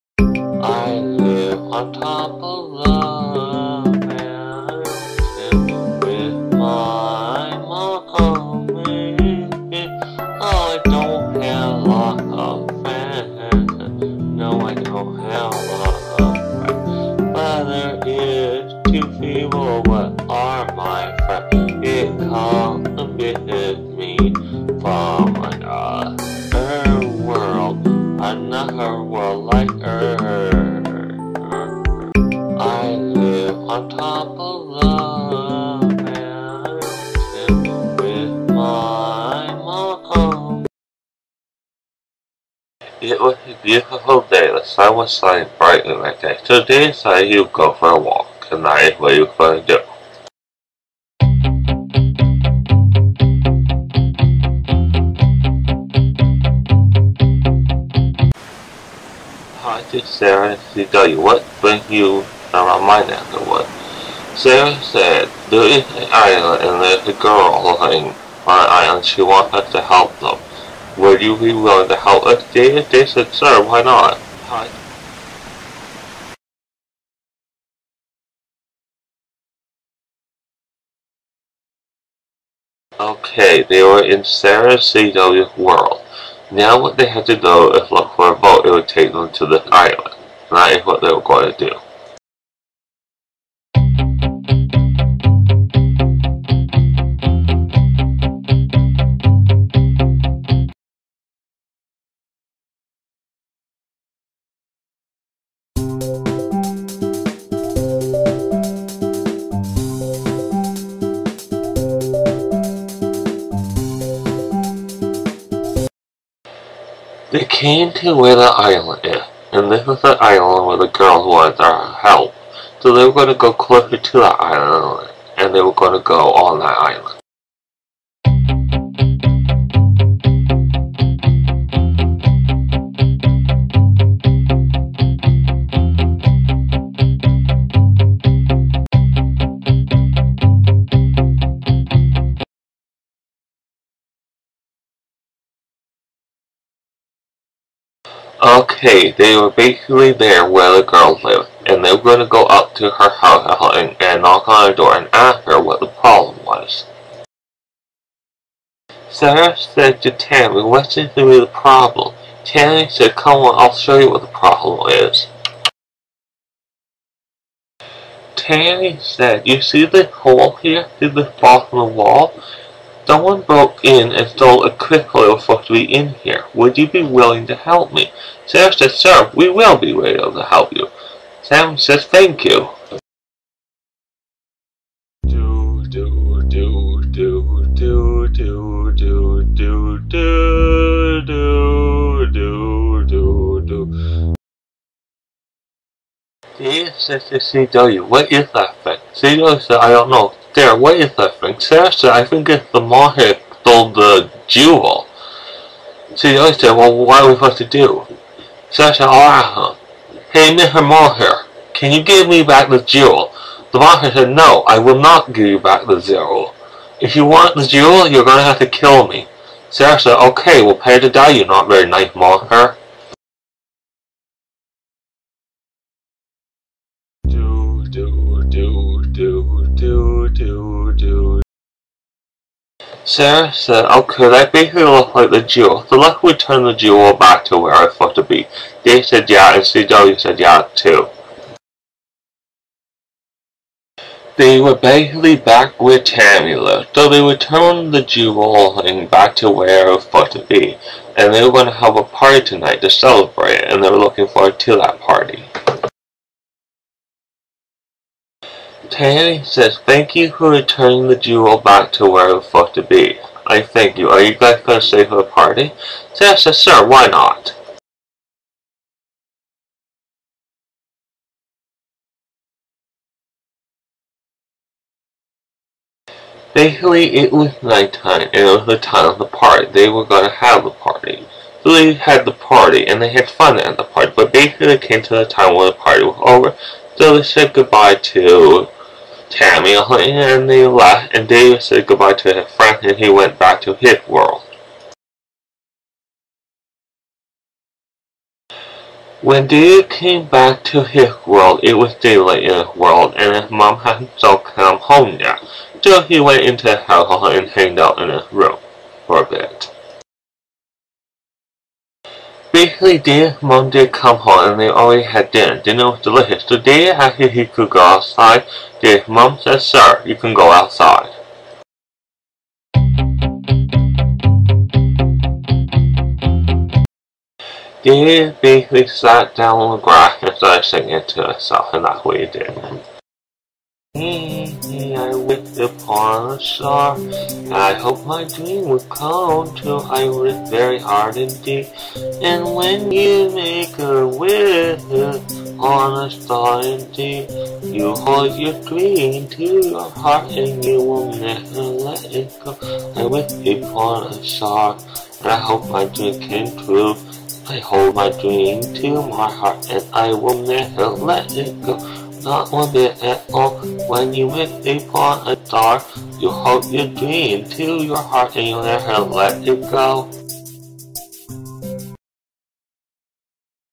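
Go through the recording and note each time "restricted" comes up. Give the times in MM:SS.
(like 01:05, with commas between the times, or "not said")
not said.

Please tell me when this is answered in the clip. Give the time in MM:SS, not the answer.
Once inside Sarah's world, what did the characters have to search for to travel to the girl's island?
01:28.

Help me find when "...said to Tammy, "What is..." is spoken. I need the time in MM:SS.
02:39.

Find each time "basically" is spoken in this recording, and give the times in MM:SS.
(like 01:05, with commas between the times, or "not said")
02:29, 03:54, 04:04, 04:36, 04:44, 05:12, 05:28.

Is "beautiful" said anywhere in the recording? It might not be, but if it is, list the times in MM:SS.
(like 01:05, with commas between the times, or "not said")
00:43.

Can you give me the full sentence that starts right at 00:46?
Today inside you go for a walk, and that is what you're going to do.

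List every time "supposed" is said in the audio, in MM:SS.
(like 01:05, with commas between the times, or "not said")
03:27, 04:10, 04:22.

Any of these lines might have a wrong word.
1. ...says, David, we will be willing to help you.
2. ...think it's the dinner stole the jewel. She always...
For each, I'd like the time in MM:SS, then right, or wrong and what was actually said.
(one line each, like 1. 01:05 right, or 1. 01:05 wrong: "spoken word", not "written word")
1. 02:58 wrong: "Sir", not "David"
2. 03:22 wrong: "monster", not "dinner".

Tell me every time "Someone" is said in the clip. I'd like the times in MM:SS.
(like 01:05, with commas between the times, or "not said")
02:53.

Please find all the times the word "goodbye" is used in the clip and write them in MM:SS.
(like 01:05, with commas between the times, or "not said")
04:47, 04:51.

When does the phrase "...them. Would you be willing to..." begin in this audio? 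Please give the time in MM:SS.
01:10.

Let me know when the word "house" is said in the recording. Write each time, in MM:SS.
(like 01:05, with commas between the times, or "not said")
02:33, 05:06.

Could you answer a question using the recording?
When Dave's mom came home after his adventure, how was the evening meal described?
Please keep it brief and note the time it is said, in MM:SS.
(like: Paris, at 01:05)
Delicious, at 05:16.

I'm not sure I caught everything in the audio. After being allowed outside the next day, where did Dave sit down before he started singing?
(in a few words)
On the grass.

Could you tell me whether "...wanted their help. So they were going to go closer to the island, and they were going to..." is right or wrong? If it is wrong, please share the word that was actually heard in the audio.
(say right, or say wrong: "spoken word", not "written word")
right.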